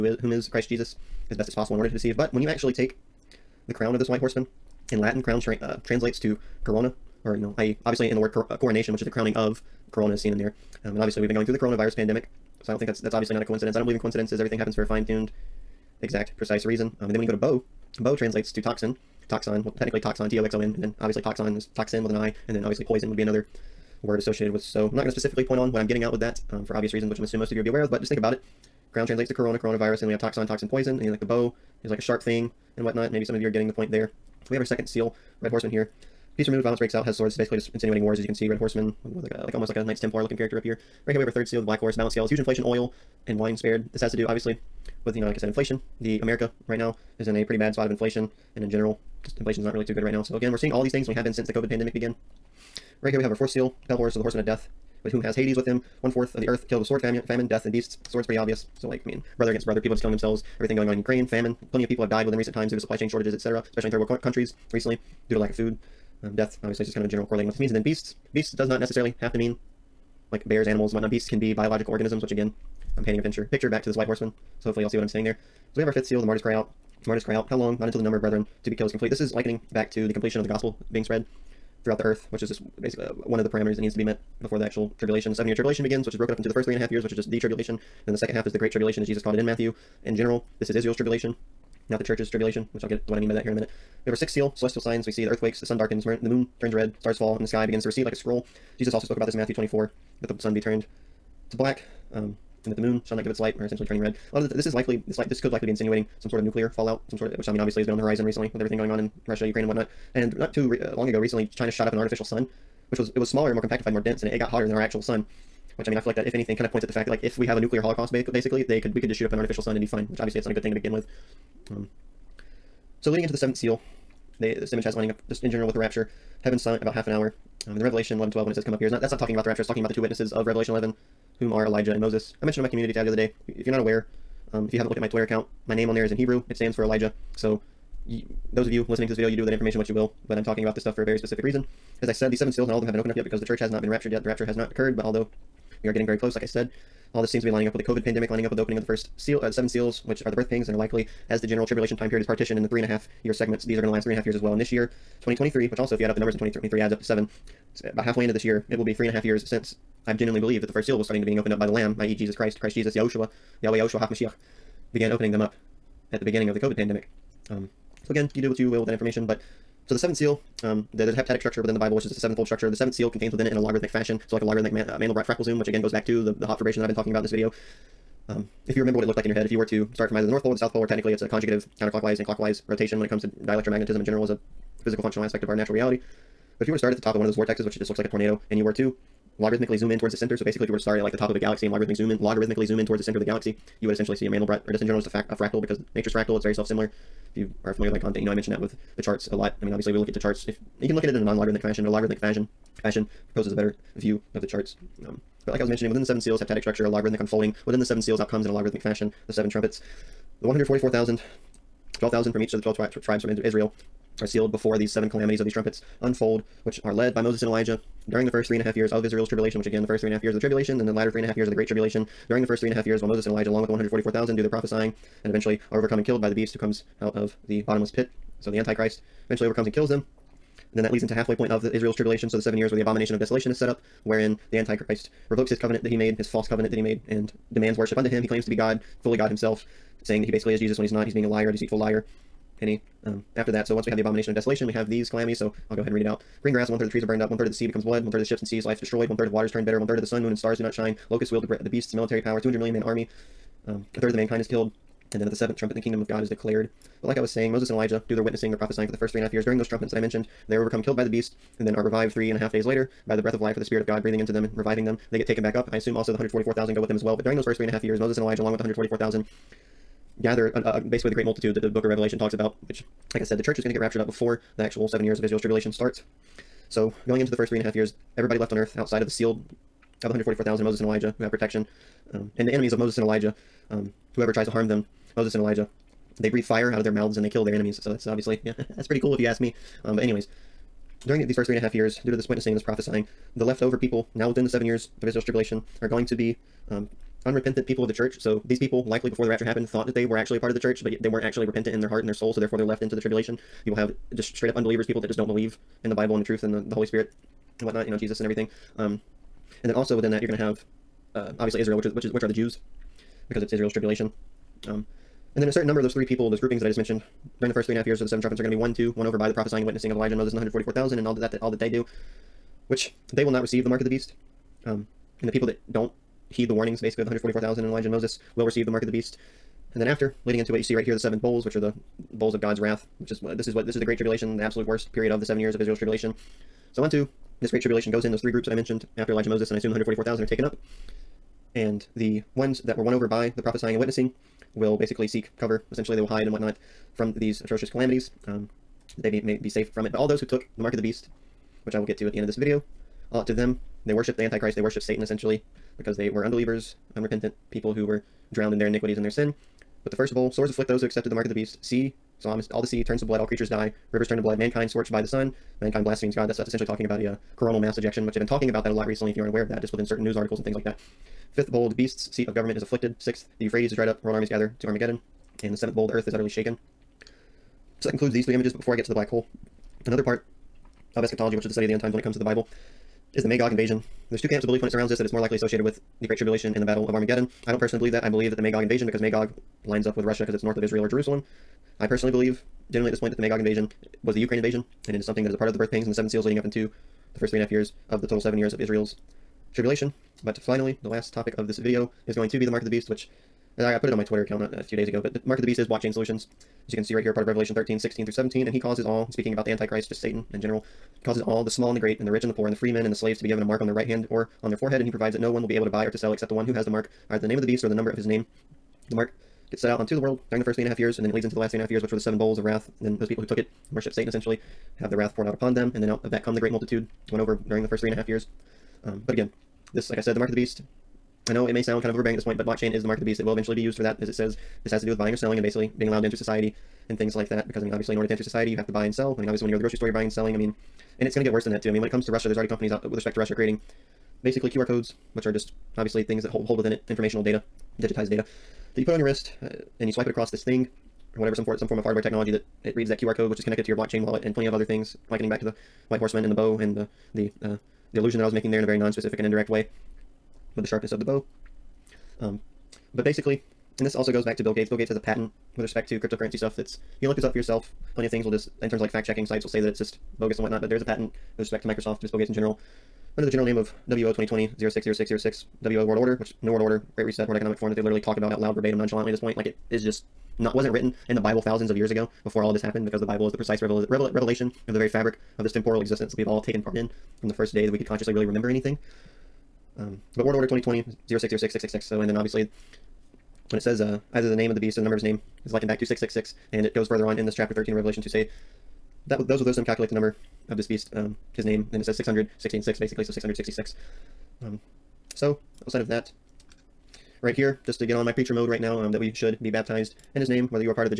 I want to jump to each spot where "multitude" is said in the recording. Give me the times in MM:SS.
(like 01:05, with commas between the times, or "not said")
04:31, 07:06.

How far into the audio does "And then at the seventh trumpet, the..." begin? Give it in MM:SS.
04:15.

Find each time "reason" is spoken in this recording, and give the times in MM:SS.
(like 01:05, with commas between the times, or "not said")
00:16, 00:26, 02:21.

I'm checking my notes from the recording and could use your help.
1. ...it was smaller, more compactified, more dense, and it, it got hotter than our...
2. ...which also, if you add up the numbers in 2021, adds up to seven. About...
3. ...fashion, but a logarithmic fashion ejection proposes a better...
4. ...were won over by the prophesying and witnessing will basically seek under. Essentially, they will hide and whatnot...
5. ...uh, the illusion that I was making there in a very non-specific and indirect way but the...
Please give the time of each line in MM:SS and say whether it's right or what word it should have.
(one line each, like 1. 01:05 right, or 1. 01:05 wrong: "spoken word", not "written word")
1. 01:53 right
2. 02:35 wrong: "2023", not "2021"
3. 03:21 wrong: "fashion", not "ejection"
4. 05:42 wrong: "cover", not "under"
5. 07:37 right.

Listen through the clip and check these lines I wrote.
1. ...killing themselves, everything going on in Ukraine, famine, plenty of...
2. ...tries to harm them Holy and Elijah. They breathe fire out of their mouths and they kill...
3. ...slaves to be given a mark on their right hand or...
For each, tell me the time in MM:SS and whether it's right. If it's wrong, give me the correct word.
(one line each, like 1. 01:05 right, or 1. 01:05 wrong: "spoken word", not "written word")
1. 01:00 right
2. 04:44 wrong: "Moses", not "Holy"
3. 06:52 right.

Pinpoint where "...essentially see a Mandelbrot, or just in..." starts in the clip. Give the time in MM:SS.
03:13.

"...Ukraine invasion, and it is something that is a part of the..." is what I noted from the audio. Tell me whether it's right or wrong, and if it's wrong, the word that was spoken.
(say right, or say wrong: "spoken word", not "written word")
right.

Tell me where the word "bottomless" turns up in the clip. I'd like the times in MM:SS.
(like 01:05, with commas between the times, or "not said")
03:47.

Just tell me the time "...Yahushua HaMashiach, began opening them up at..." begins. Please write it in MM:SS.
02:43.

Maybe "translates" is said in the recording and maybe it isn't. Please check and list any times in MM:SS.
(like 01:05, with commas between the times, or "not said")
00:05, 00:18, 00:29.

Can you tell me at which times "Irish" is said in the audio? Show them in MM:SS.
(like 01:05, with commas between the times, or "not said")
not said.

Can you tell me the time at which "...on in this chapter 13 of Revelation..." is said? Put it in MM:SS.
08:17.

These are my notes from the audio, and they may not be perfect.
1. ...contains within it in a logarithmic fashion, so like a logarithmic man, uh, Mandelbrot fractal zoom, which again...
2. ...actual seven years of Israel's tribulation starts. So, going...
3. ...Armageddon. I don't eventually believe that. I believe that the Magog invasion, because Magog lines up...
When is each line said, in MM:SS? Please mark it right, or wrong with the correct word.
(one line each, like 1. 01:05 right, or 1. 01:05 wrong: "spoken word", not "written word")
1. 02:53 right
2. 04:34 right
3. 06:26 wrong: "personally", not "eventually".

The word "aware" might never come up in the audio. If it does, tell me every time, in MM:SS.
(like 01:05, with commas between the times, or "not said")
00:27, 02:13, 06:09.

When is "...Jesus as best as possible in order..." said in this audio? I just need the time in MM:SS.
00:00.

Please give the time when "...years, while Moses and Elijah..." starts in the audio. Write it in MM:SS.
03:42.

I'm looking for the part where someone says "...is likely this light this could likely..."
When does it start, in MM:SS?
01:44.